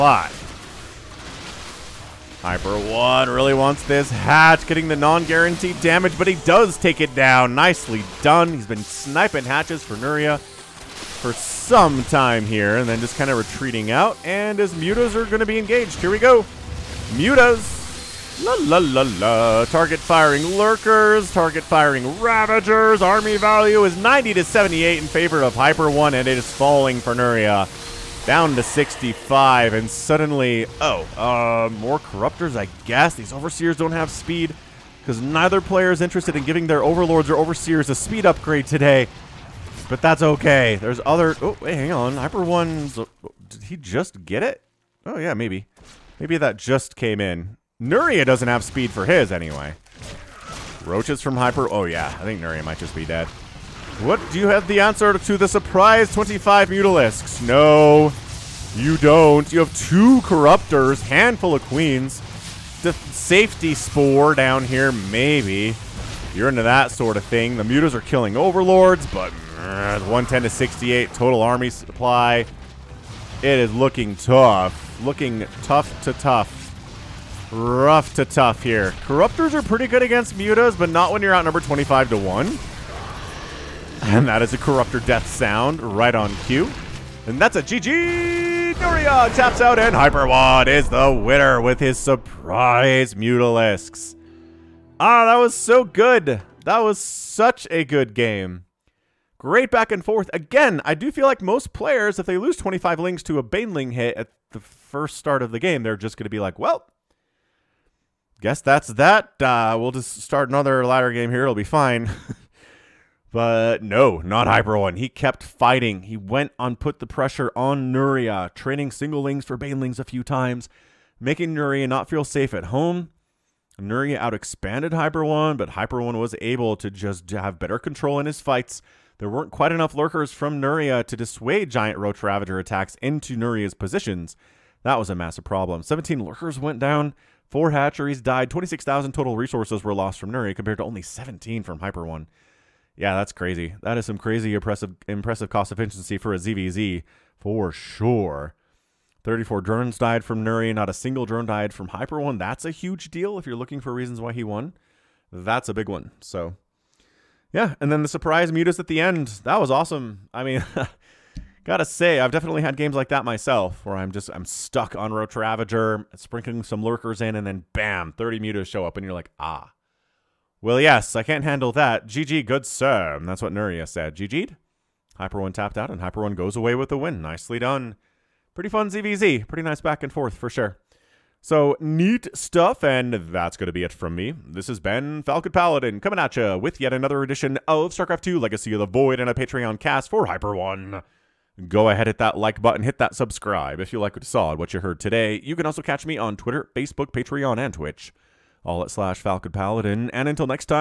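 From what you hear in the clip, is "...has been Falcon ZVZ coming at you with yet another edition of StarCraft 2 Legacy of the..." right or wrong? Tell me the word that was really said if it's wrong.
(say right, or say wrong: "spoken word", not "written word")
wrong: "Paladin", not "ZVZ".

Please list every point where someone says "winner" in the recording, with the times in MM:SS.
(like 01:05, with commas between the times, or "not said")
01:31.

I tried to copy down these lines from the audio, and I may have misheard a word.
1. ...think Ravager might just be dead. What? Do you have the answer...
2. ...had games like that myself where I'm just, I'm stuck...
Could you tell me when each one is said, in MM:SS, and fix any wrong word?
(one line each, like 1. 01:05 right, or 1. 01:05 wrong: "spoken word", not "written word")
1. 00:52 wrong: "Nuria", not "Ravager"
2. 02:42 right.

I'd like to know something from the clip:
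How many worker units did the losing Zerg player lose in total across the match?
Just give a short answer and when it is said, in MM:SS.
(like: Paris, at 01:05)
34, at 02:29.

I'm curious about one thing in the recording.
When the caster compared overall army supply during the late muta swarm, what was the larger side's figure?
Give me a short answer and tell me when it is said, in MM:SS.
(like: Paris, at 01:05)
110, at 01:09.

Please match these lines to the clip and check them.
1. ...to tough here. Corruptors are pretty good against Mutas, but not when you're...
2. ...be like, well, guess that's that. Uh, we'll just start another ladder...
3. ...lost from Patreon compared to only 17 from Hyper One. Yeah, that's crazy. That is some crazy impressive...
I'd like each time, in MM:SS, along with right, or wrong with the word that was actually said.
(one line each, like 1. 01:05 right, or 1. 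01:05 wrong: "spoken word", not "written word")
1. 01:18 right
2. 01:46 right
3. 02:19 wrong: "Nuria", not "Patreon".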